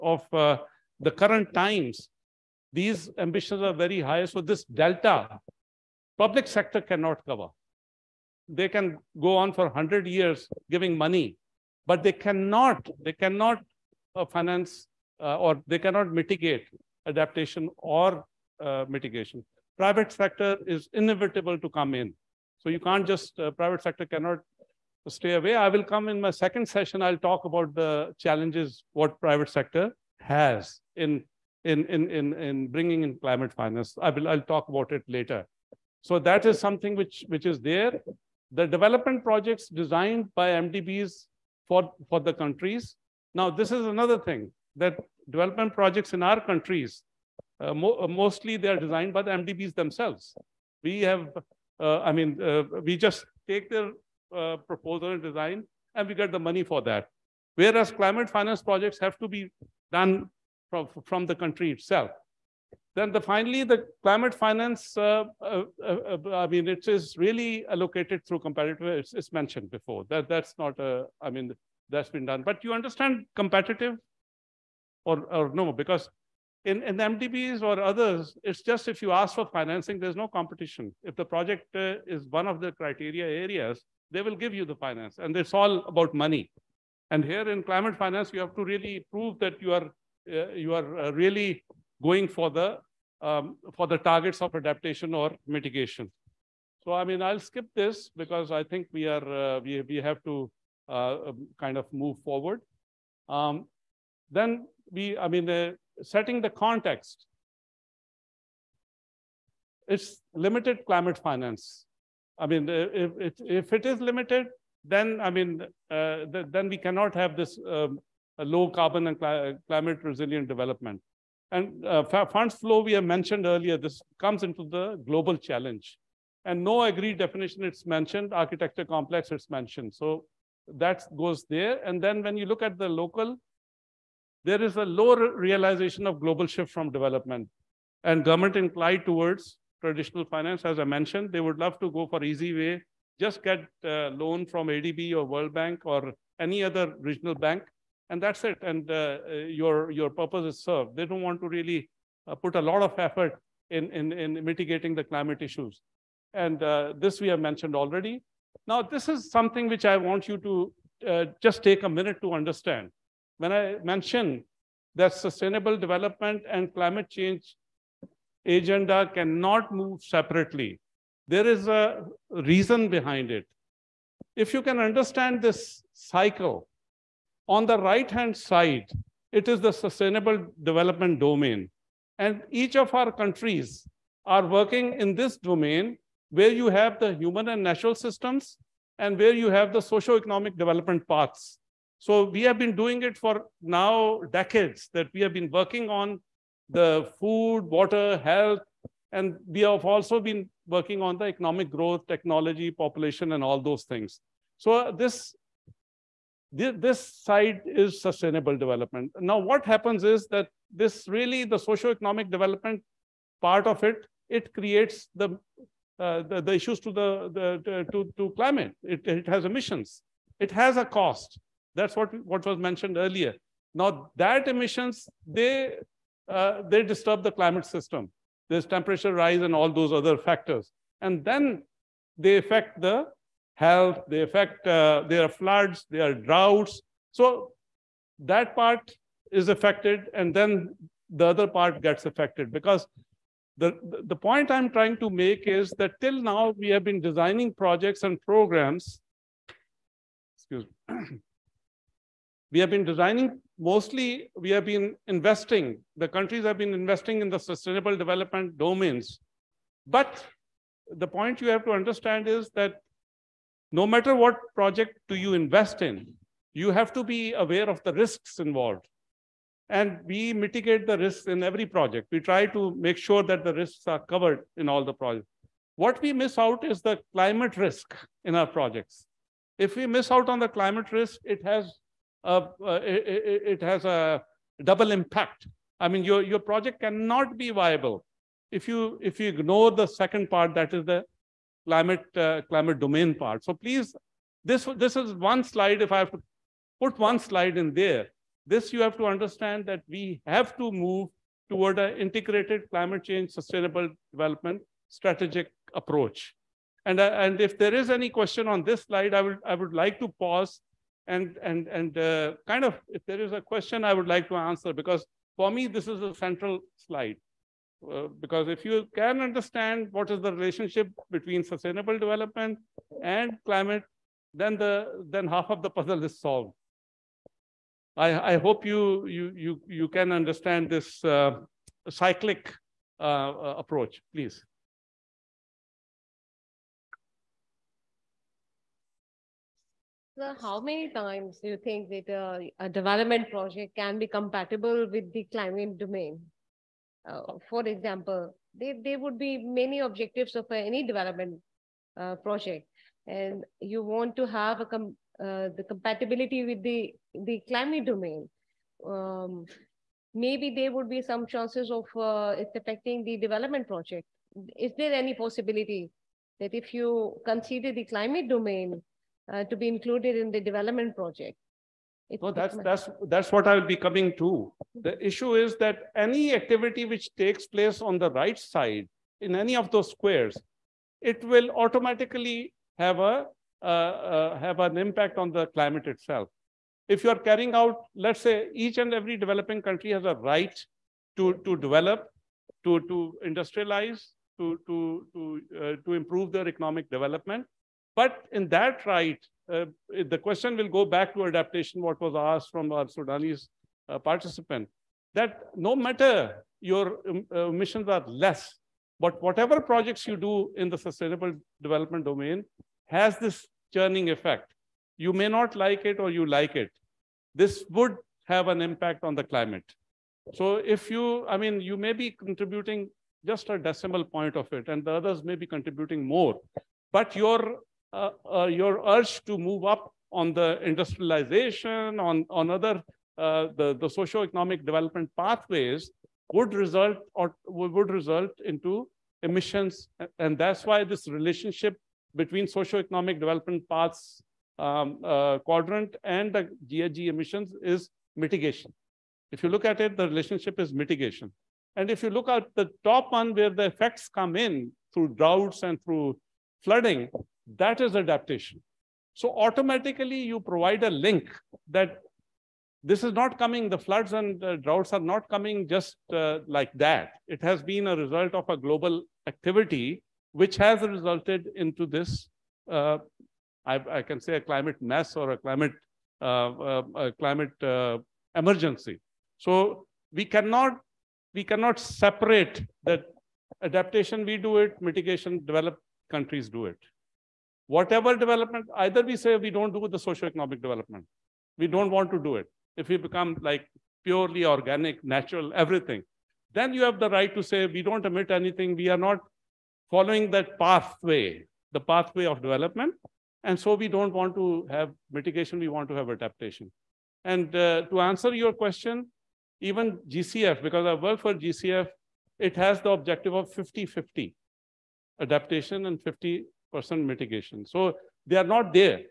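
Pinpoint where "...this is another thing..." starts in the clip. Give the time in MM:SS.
00:43.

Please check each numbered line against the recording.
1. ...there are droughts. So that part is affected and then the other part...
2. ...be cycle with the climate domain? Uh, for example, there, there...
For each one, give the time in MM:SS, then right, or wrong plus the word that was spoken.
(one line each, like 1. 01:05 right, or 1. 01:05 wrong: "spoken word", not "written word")
1. 03:55 right
2. 05:43 wrong: "compatible", not "cycle".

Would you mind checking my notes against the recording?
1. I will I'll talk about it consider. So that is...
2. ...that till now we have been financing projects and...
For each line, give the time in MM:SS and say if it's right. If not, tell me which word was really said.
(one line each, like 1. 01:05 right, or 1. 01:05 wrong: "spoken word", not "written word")
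1. 00:34 wrong: "later", not "consider"
2. 04:05 wrong: "designing", not "financing".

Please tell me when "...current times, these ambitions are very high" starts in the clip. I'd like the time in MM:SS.
00:01.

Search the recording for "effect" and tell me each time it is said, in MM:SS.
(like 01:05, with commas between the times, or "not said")
06:54, 07:33.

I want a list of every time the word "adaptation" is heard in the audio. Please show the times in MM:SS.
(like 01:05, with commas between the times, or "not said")
00:17, 01:34, 06:41, 07:37, 08:03, 08:26, 08:35.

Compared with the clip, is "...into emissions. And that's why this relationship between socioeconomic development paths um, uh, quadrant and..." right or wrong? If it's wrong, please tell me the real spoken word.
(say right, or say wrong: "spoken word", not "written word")
right.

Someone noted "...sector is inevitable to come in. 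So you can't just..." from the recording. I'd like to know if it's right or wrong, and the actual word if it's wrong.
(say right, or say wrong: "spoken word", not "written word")
right.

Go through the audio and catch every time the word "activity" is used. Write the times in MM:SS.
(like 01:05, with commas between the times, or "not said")
06:16, 07:49.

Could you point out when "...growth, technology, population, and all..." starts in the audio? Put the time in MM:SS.
03:21.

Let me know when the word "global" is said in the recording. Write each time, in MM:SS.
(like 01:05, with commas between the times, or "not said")
02:05, 02:16, 07:48.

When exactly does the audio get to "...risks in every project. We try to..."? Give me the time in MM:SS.
04:30.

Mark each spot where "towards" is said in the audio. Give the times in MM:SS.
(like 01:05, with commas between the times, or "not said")
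02:19, 05:01.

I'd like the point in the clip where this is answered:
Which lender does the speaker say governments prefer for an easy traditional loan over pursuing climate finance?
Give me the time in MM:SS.
02:24.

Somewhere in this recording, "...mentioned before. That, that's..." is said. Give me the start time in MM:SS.
01:09.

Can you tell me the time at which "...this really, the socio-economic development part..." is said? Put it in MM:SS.
03:30.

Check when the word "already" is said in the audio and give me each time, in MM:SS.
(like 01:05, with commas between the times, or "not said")
02:37.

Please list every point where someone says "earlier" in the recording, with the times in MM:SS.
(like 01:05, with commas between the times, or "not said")
02:03, 03:42.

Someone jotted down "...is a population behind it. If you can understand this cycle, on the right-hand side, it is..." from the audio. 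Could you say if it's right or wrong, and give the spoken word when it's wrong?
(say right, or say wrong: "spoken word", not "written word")
wrong: "reason", not "population".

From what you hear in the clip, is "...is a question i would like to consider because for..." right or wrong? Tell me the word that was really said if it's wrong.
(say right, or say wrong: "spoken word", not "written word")
wrong: "answer", not "consider".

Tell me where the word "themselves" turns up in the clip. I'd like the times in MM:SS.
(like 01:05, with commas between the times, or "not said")
00:49.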